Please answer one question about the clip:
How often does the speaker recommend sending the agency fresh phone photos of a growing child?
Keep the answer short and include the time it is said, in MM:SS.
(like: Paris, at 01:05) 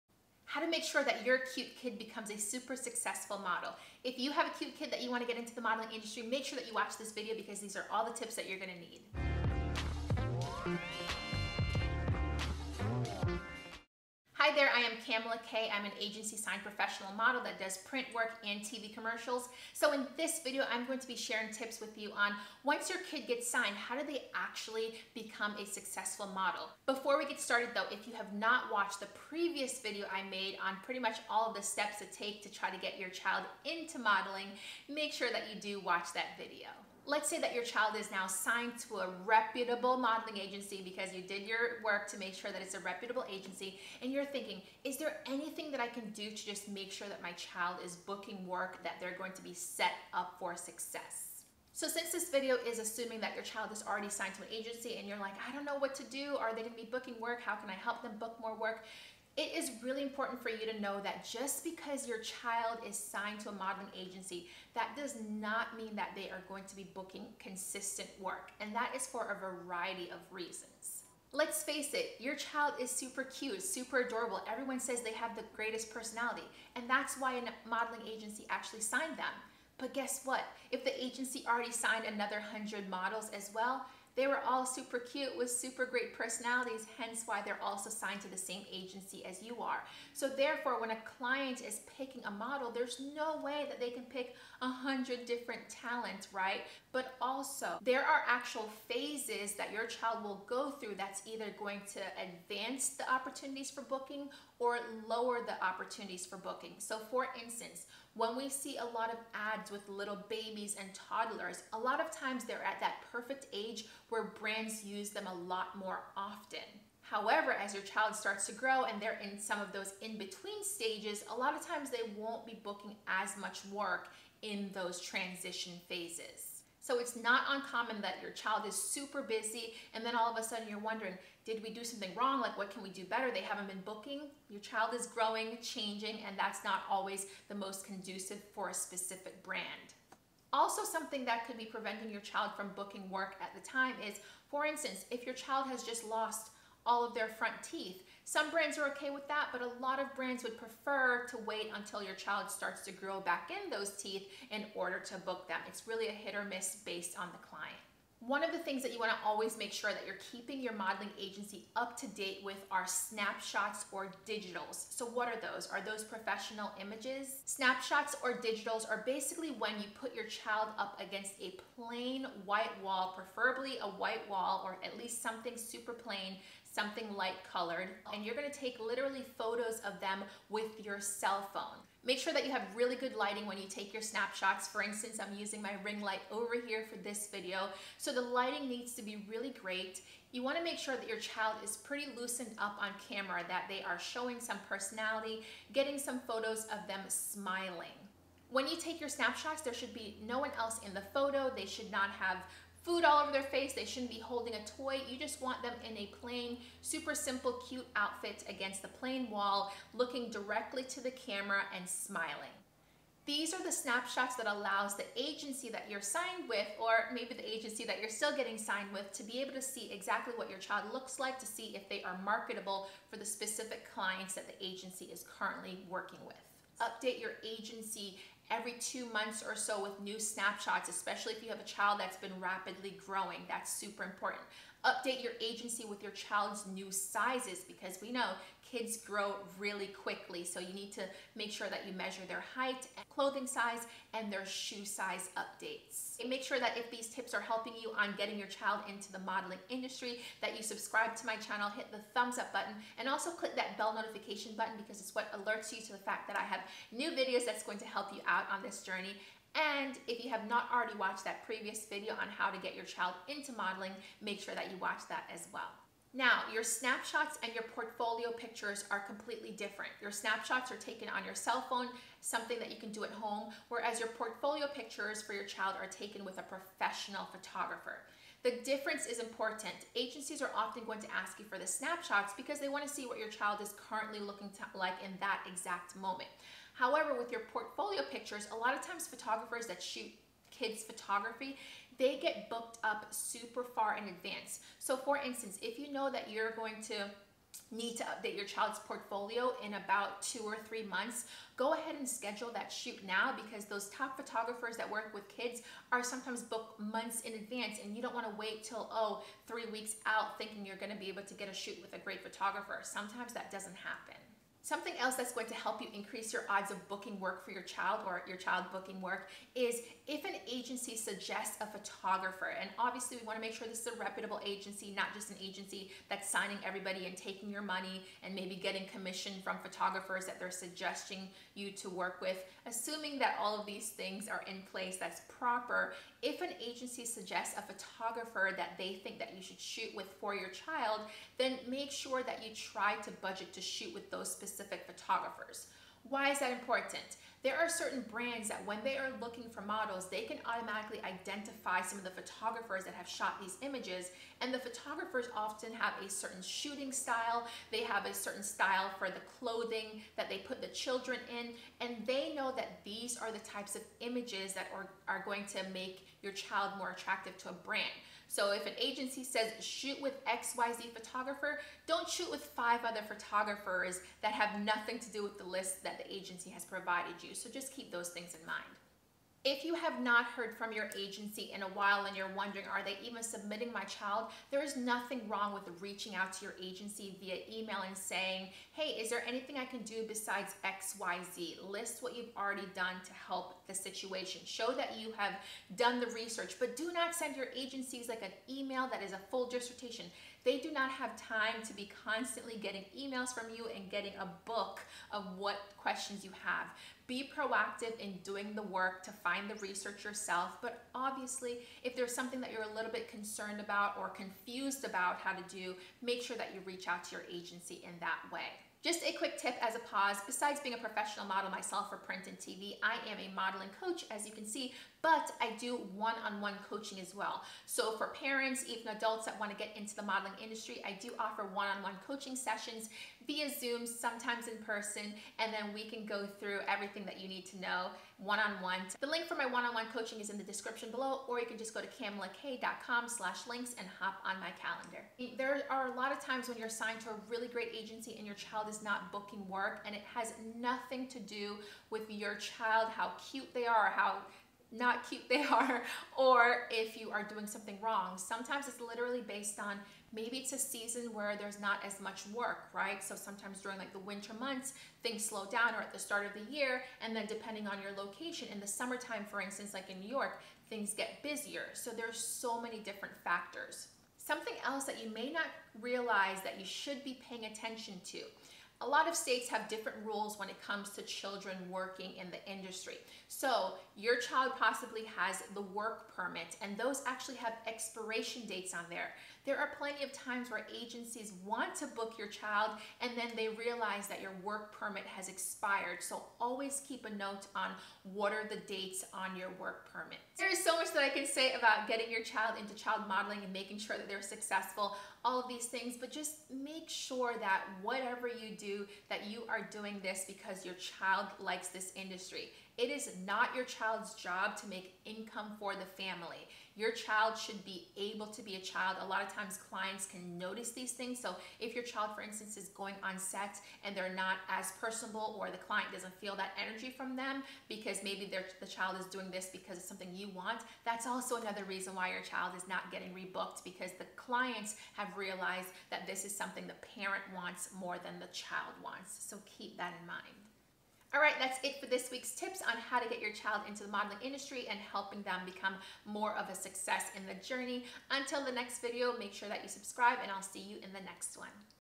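every 2 months, at 03:48.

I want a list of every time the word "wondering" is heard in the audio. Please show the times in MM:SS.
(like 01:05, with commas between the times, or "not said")
02:10, 06:22.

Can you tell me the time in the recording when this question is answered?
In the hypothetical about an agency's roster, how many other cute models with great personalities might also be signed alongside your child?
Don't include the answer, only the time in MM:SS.
01:22.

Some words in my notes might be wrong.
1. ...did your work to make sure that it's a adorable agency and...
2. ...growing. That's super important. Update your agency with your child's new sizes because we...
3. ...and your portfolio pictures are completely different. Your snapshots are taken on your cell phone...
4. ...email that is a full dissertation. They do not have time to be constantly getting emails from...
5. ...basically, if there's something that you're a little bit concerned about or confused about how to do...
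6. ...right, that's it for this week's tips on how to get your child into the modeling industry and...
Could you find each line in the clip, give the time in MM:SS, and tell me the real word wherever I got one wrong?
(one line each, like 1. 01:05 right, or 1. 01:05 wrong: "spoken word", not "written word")
1. 00:41 wrong: "reputable", not "adorable"
2. 03:53 right
3. 04:27 right
4. 06:38 right
5. 06:50 wrong: "obviously", not "basically"
6. 09:01 right.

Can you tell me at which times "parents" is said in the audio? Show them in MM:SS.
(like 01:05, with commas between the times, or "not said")
07:08, 08:56.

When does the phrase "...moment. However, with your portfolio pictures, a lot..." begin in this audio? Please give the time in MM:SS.
04:45.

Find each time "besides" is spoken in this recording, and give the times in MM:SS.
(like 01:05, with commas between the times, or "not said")
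06:30, 07:00.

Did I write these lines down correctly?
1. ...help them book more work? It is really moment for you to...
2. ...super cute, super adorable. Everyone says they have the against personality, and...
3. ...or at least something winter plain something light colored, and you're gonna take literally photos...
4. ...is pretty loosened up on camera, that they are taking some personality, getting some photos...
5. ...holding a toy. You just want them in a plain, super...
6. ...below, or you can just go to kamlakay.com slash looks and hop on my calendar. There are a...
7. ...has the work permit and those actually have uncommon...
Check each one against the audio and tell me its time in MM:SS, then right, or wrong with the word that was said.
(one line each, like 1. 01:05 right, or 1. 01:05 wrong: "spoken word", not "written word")
1. 00:57 wrong: "important", not "moment"
2. 01:12 wrong: "greatest", not "against"
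3. 02:54 wrong: "super", not "winter"
4. 03:11 wrong: "showing", not "taking"
5. 03:24 right
6. 07:20 wrong: "links", not "looks"
7. 08:05 wrong: "expiration", not "uncommon".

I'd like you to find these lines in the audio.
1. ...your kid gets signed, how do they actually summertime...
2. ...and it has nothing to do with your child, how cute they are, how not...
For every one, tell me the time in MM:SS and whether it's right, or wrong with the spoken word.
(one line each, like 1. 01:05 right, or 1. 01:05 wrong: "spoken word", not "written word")
1. 00:22 wrong: "become", not "summertime"
2. 07:29 right.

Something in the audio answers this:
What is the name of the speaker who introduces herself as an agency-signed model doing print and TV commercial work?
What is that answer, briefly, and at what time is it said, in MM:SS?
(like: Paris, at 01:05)
Kamala Kay, at 00:15.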